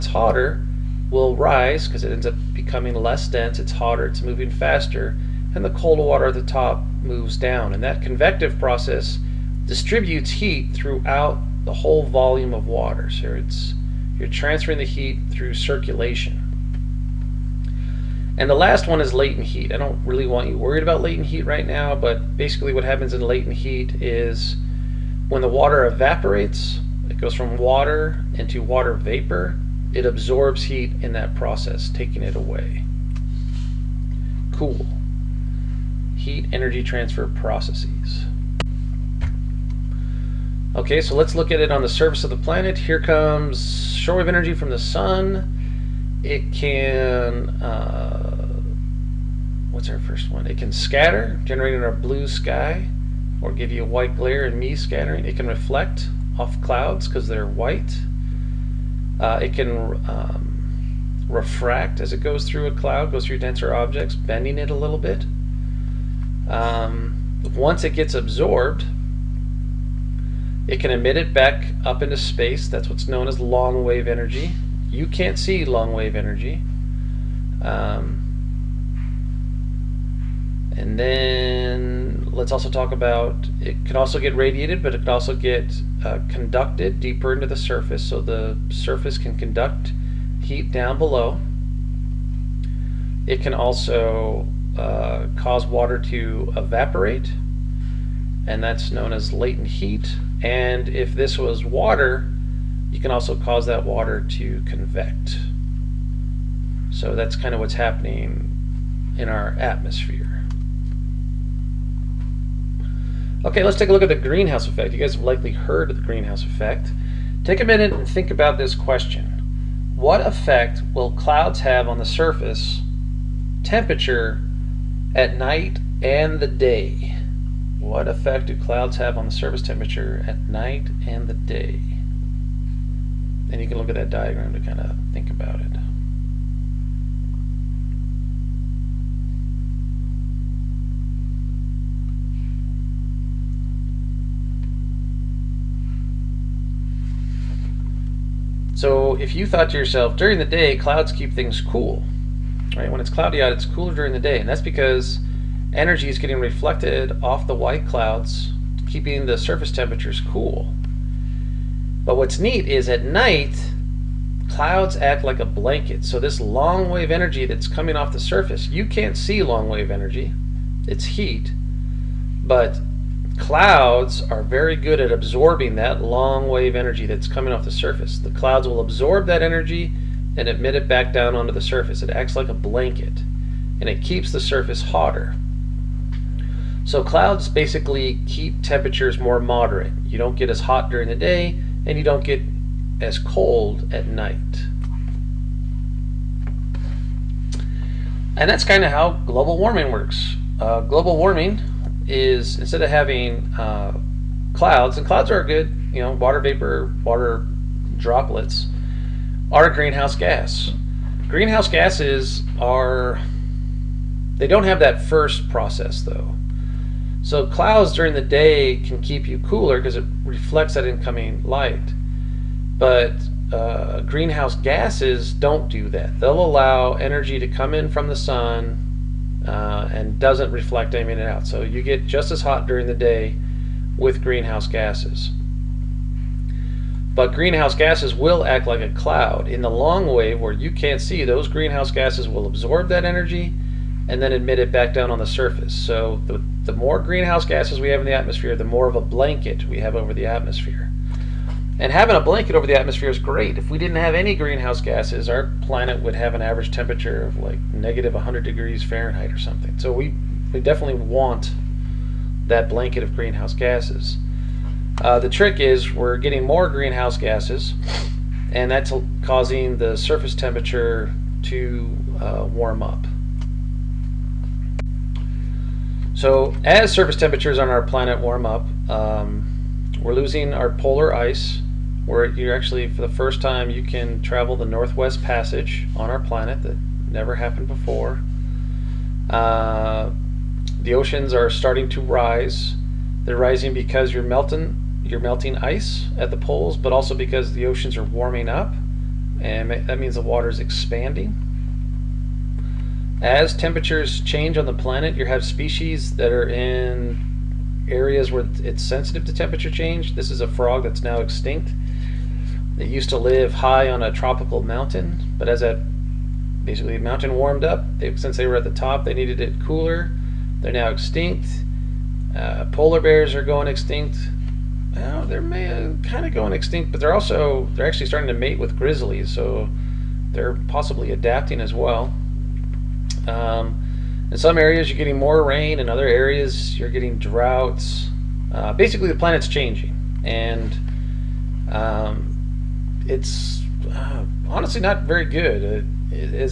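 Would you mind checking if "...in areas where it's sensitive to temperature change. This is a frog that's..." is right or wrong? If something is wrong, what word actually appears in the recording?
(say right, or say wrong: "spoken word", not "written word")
right.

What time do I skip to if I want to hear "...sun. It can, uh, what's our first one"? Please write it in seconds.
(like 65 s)
44 s.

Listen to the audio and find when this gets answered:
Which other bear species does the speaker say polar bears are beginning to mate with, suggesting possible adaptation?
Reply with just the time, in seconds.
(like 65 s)
328 s.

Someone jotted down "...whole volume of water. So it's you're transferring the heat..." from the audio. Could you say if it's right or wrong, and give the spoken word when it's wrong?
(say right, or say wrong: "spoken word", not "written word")
right.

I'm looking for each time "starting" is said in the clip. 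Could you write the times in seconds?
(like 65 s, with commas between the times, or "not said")
291 s, 328 s.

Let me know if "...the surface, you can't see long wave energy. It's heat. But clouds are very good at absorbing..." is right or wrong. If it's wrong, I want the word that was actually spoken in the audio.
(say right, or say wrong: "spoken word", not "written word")
right.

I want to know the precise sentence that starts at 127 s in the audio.
What effect do clouds have on the surface temperature at night and the day?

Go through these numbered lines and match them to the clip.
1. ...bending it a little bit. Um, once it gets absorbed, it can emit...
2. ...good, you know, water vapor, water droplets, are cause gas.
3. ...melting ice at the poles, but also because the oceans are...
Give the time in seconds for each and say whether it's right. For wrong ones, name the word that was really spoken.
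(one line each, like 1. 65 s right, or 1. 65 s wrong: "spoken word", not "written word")
1. 64 s right
2. 205 s wrong: "greenhouse", not "cause"
3. 295 s right.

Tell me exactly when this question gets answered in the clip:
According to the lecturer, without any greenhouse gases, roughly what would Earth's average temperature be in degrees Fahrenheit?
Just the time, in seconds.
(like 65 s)
257 s.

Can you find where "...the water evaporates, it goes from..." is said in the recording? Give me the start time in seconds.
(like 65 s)
25 s.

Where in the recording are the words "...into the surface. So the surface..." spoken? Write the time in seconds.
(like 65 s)
87 s.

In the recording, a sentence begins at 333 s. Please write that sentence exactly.
Um, in some areas, you're getting more rain.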